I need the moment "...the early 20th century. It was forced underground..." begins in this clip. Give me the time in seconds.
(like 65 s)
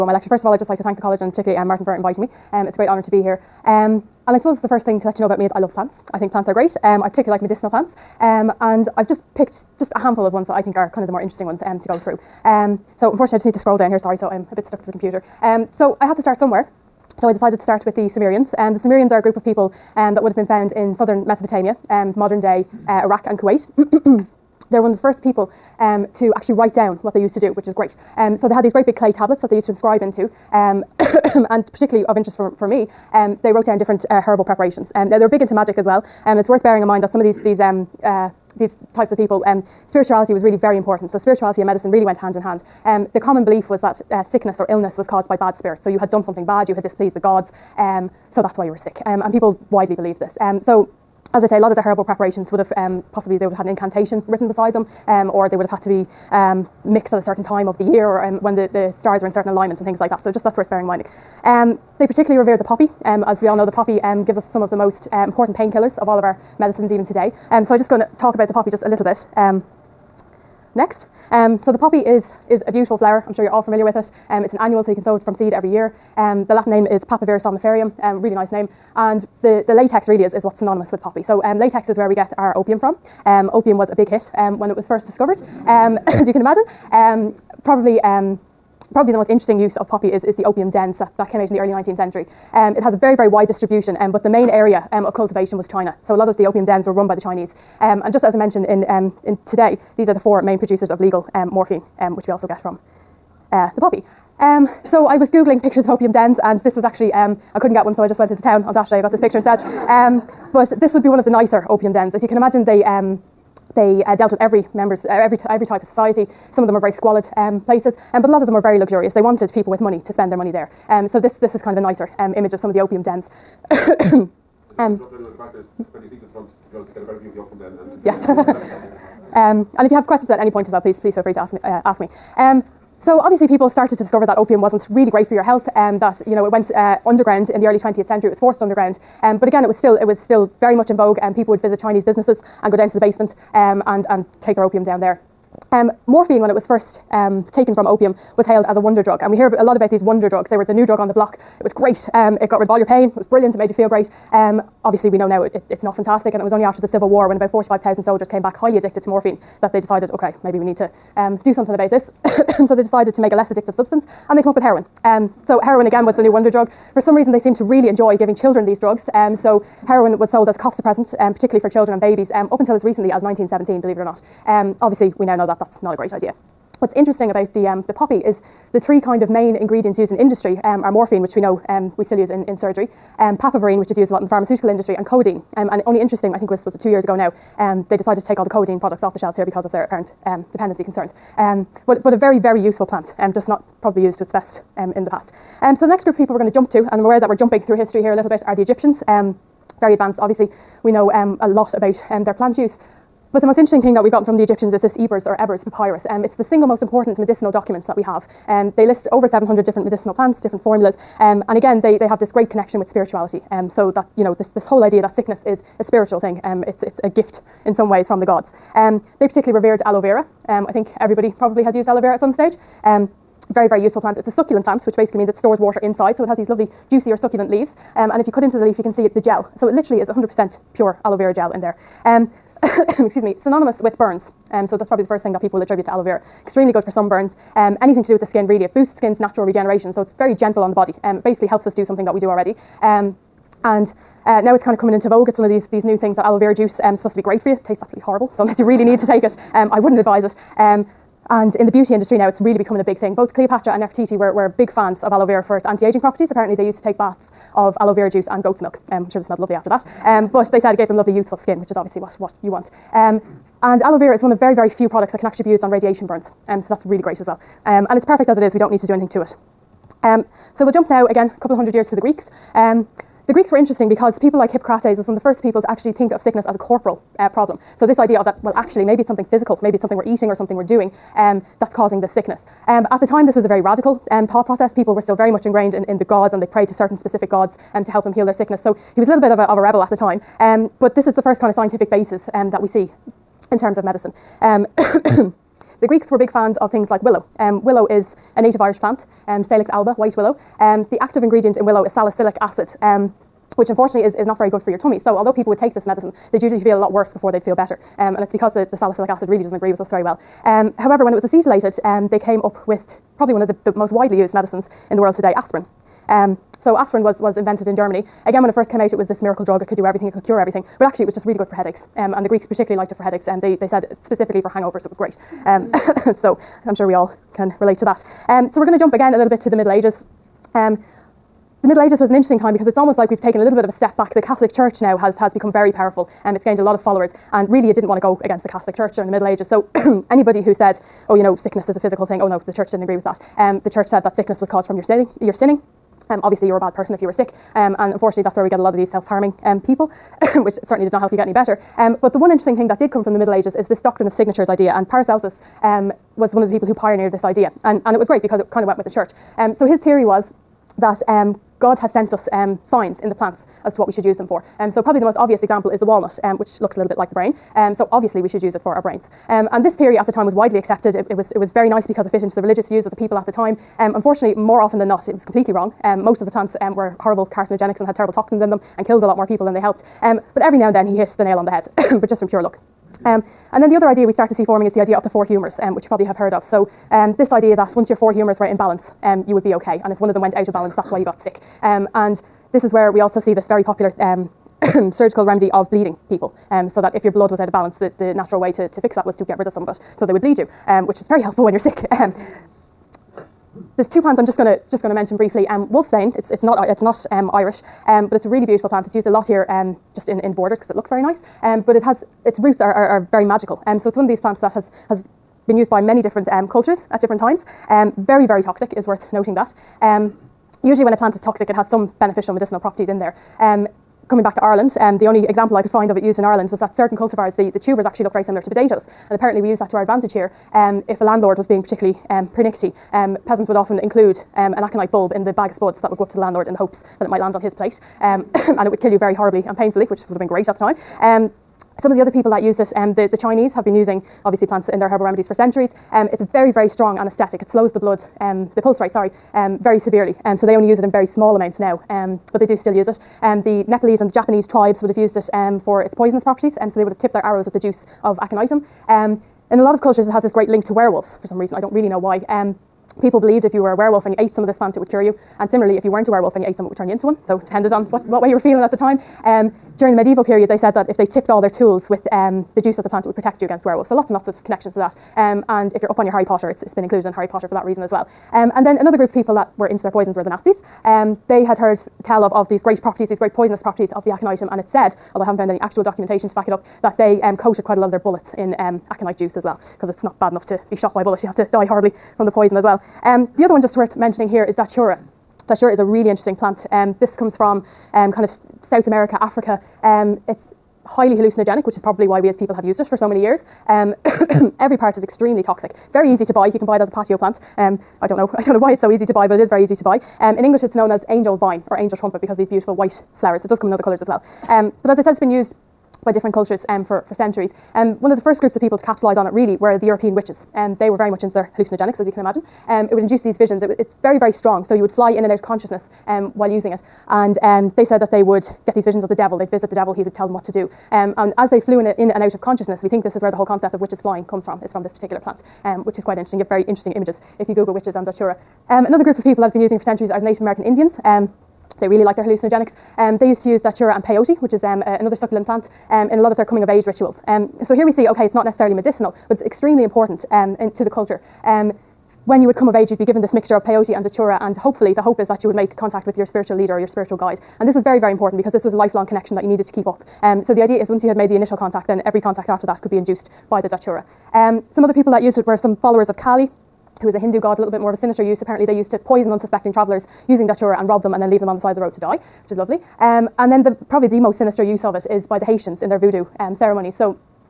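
137 s.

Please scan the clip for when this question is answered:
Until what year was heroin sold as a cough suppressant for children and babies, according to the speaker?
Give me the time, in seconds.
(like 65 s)
173 s.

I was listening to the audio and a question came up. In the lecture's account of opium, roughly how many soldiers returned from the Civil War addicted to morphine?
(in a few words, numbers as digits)
45,000.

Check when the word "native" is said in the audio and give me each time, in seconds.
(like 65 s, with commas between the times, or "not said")
298 s, 540 s.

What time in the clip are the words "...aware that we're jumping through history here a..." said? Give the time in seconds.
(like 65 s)
197 s.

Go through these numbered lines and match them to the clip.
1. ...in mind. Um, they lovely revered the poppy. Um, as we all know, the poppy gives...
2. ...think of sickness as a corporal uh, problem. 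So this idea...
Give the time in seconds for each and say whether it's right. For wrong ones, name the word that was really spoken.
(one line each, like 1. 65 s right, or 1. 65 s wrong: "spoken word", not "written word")
1. 60 s wrong: "particularly", not "lovely"
2. 275 s right.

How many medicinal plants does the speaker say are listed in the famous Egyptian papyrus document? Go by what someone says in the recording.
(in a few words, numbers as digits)
over 700.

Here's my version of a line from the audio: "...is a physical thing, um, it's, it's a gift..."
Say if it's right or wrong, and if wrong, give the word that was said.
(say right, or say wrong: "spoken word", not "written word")
wrong: "spiritual", not "physical".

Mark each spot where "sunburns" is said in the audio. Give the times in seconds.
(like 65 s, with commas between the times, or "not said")
236 s.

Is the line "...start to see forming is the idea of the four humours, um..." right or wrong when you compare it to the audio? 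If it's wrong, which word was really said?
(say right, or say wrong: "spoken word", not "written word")
right.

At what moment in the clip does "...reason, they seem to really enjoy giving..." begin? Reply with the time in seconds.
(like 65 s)
167 s.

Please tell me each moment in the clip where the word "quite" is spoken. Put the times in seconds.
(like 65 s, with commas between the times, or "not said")
487 s, 536 s.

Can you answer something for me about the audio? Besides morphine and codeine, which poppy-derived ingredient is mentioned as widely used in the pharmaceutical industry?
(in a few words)
papaverine.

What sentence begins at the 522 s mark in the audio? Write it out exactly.
Um, it would induce these visions.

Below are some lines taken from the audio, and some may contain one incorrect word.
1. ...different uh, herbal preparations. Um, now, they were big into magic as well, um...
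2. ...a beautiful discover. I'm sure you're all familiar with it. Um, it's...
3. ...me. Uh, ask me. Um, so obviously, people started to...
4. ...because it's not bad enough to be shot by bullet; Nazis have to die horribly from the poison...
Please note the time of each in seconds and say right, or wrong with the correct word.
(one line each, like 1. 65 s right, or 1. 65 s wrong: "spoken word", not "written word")
1. 33 s right
2. 72 s wrong: "flower", not "discover"
3. 131 s right
4. 489 s wrong: "You", not "Nazis".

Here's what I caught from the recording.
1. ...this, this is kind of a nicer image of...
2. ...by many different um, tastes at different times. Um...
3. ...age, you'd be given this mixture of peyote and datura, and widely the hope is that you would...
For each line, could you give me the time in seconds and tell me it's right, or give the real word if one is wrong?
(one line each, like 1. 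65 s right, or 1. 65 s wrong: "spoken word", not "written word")
1. 121 s right
2. 415 s wrong: "cultures", not "tastes"
3. 552 s wrong: "hopefully", not "widely".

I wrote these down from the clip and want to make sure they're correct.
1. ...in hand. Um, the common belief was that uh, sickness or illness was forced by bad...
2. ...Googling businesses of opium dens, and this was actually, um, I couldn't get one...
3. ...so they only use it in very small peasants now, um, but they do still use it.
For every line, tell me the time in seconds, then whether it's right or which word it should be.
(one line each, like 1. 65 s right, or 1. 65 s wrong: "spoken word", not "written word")
1. 42 s wrong: "caused", not "forced"
2. 105 s wrong: "pictures", not "businesses"
3. 450 s wrong: "amounts", not "peasants".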